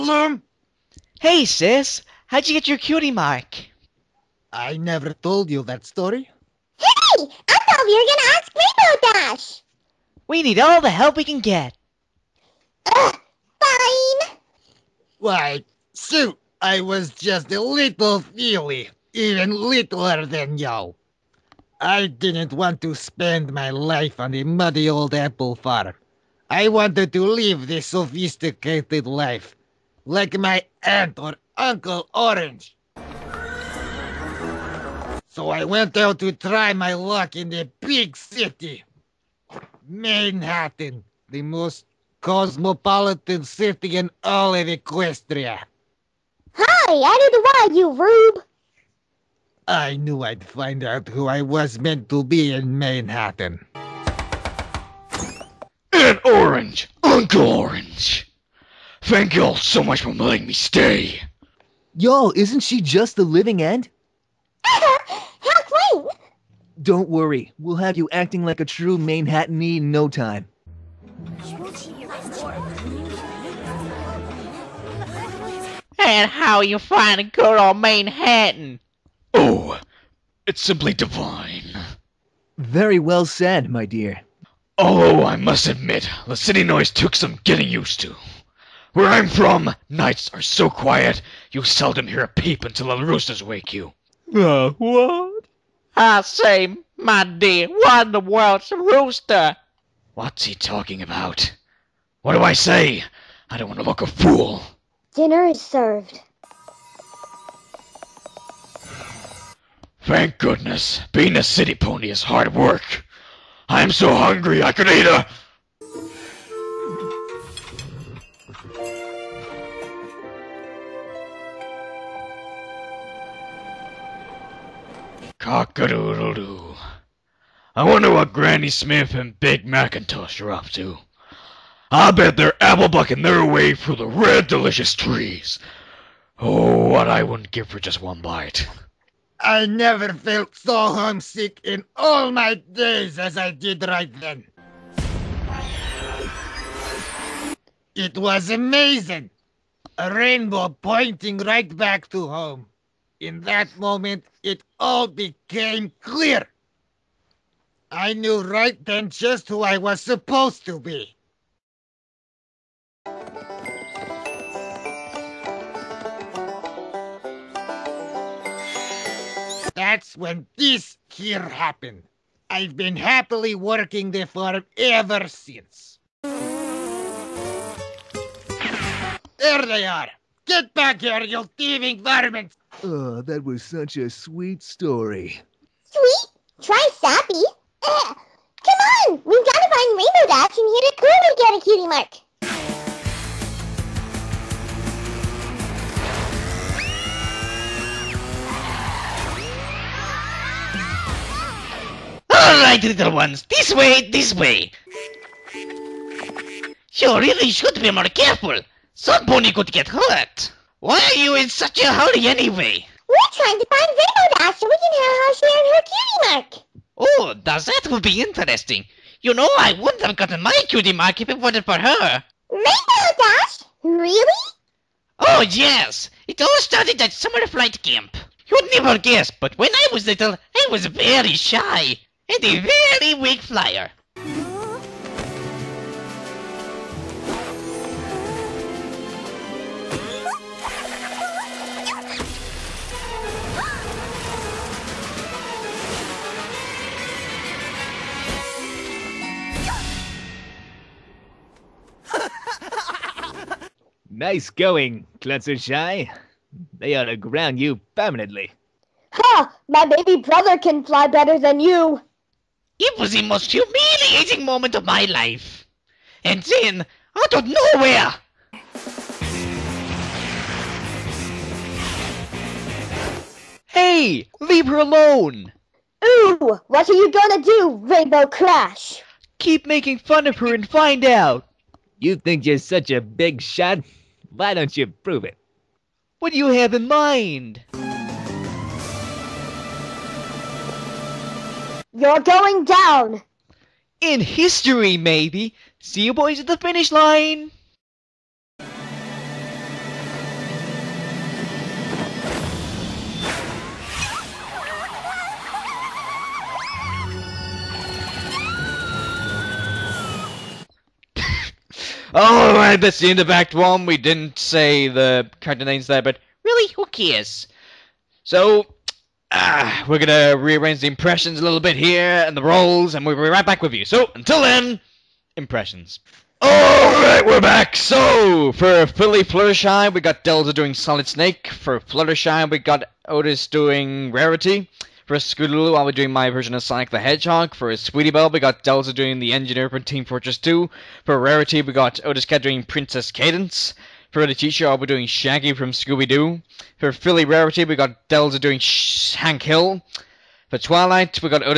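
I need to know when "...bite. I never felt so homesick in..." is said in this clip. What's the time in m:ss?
2:18.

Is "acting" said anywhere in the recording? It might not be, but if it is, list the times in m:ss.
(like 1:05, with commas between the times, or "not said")
1:08.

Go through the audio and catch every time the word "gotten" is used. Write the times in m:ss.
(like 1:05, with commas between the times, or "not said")
3:40.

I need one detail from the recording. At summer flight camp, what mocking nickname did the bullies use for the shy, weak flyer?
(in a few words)
Klutzershy.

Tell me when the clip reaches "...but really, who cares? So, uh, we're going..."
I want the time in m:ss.
5:16.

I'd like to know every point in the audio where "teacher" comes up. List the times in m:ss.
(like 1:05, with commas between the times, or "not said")
5:44.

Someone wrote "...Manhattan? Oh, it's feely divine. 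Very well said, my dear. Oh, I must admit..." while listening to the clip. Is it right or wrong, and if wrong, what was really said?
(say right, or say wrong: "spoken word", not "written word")
wrong: "simply", not "feely".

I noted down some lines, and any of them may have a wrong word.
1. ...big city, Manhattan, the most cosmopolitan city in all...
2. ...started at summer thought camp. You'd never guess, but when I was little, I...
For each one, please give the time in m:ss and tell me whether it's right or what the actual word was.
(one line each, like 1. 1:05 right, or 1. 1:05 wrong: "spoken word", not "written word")
1. 0:37 right
2. 3:46 wrong: "flight", not "thought".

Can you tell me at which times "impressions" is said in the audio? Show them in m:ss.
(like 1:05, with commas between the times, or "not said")
5:20, 5:25.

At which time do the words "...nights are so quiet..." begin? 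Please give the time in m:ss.
1:29.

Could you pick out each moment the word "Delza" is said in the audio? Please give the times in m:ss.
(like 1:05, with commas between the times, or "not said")
5:30, 5:38, 5:48.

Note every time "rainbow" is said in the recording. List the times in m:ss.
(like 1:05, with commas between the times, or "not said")
0:09, 2:30, 3:09, 3:33, 3:42, 4:37.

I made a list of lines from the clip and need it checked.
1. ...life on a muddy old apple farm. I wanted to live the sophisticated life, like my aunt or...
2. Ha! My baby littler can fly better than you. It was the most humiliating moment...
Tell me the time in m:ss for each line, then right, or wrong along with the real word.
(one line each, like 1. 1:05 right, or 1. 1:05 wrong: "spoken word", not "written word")
1. 0:23 right
2. 4:19 wrong: "brother", not "littler".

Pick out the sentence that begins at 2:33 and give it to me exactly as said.
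In that moment, it all became clear.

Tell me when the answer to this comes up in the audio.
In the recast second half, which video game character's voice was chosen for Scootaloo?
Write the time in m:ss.
5:36.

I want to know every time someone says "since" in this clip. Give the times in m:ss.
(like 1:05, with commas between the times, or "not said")
2:55.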